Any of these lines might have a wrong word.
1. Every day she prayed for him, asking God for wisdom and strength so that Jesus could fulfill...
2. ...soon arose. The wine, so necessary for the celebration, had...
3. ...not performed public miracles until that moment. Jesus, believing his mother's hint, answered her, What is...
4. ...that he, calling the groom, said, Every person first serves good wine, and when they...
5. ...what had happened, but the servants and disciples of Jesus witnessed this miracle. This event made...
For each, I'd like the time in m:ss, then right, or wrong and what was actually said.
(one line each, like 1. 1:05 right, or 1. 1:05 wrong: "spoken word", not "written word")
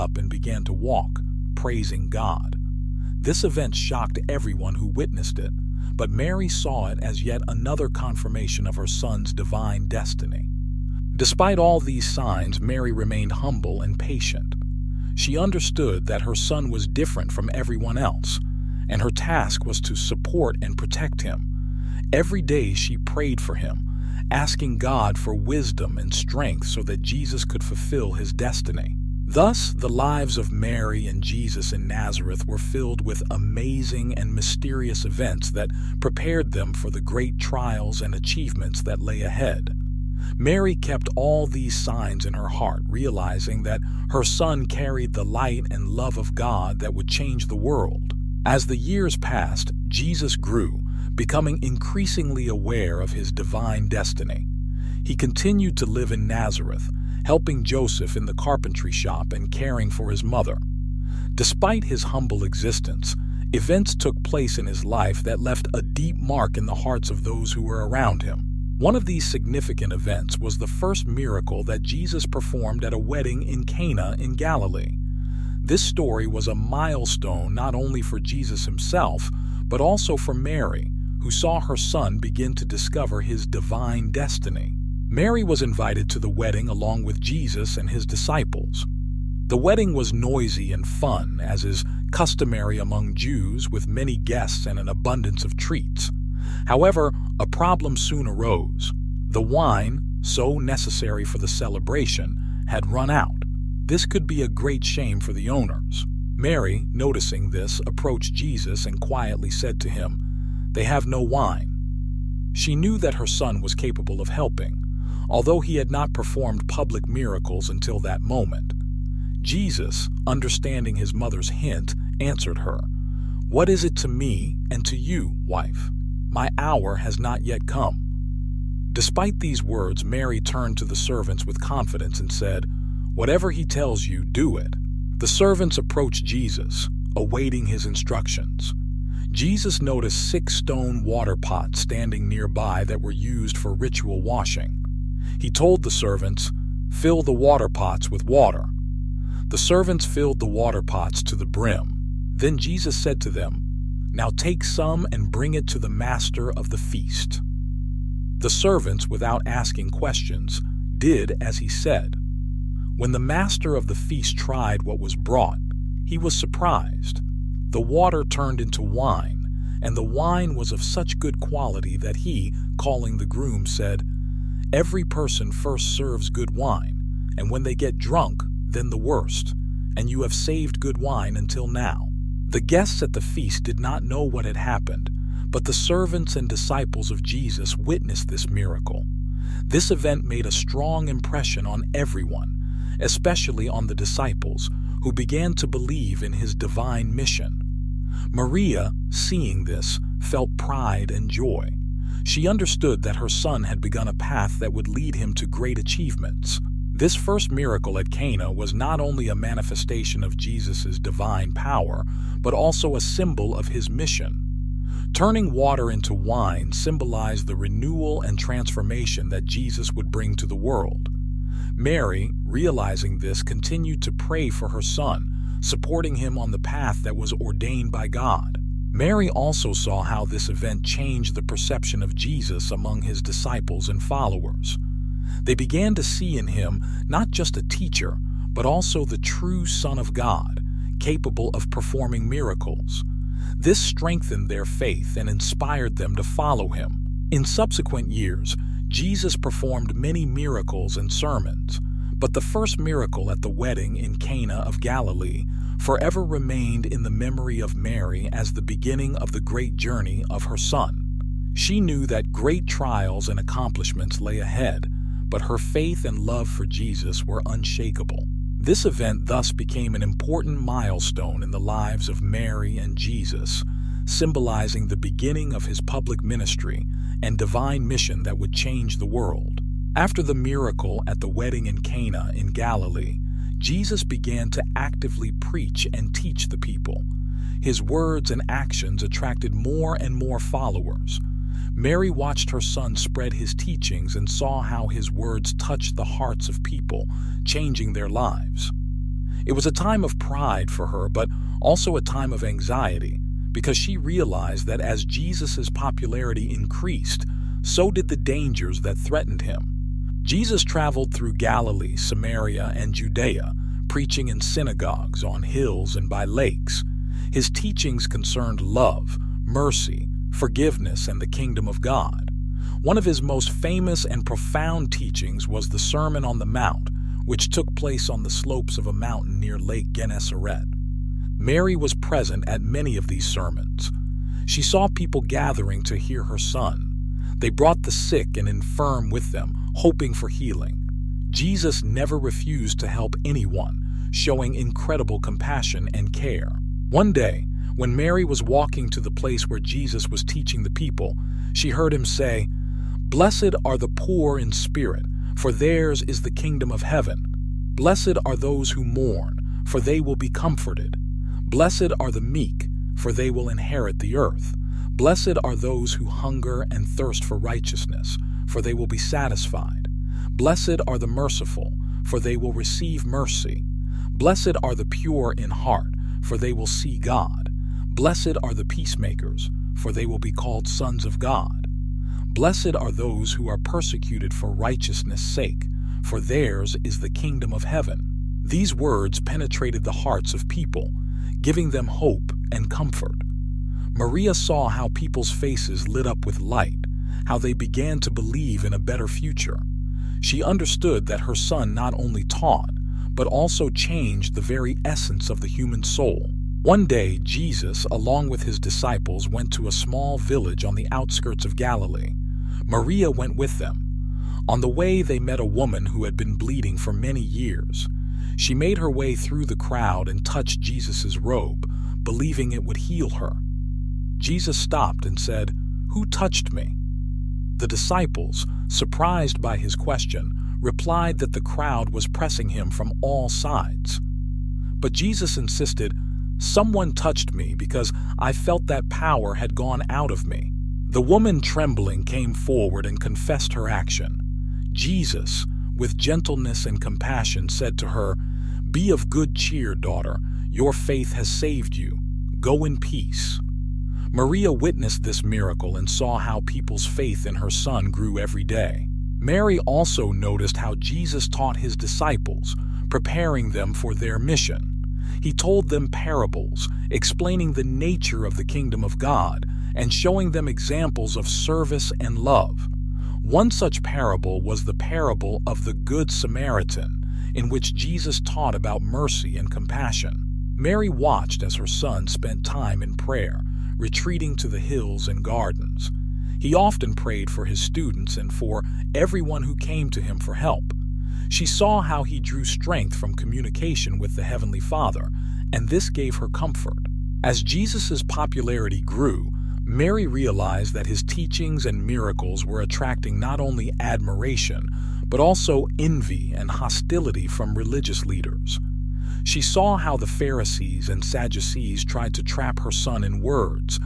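1. 0:22 right
2. 1:37 right
3. 1:55 wrong: "understanding", not "believing"
4. 2:51 right
5. 3:04 right.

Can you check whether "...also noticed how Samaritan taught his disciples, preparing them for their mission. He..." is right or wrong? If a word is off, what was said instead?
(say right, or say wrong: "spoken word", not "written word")
wrong: "Jesus", not "Samaritan".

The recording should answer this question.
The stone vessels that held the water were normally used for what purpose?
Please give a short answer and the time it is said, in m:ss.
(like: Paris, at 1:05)
ritual washing, at 2:23.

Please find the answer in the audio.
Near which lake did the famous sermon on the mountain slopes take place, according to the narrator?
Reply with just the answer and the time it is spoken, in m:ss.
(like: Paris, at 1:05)
Lake Gennesaret, at 5:29.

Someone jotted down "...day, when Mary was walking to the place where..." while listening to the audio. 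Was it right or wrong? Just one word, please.
right.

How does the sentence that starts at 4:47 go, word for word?
His words and actions attracted more and more followers.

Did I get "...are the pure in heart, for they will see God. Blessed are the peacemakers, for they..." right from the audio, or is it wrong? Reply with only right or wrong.
right.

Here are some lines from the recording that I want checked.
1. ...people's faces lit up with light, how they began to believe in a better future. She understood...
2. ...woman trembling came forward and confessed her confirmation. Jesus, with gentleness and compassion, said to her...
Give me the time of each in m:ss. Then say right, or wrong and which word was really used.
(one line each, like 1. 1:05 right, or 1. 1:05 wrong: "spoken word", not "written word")
1. 6:34 right
2. 7:21 wrong: "action", not "confirmation".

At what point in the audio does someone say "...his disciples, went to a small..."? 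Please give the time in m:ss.
6:48.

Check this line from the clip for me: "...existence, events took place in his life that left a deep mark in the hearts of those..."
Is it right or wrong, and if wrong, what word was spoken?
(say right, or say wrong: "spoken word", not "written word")
right.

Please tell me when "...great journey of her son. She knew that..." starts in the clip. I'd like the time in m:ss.
4:19.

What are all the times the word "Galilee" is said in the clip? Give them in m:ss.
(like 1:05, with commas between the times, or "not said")
1:14, 4:14, 4:42, 5:11, 6:51.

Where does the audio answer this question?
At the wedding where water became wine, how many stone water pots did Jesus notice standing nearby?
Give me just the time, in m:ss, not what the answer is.
2:20.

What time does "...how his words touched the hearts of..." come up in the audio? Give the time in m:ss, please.
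4:54.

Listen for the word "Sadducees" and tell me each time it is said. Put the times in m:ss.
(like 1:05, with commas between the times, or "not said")
8:31.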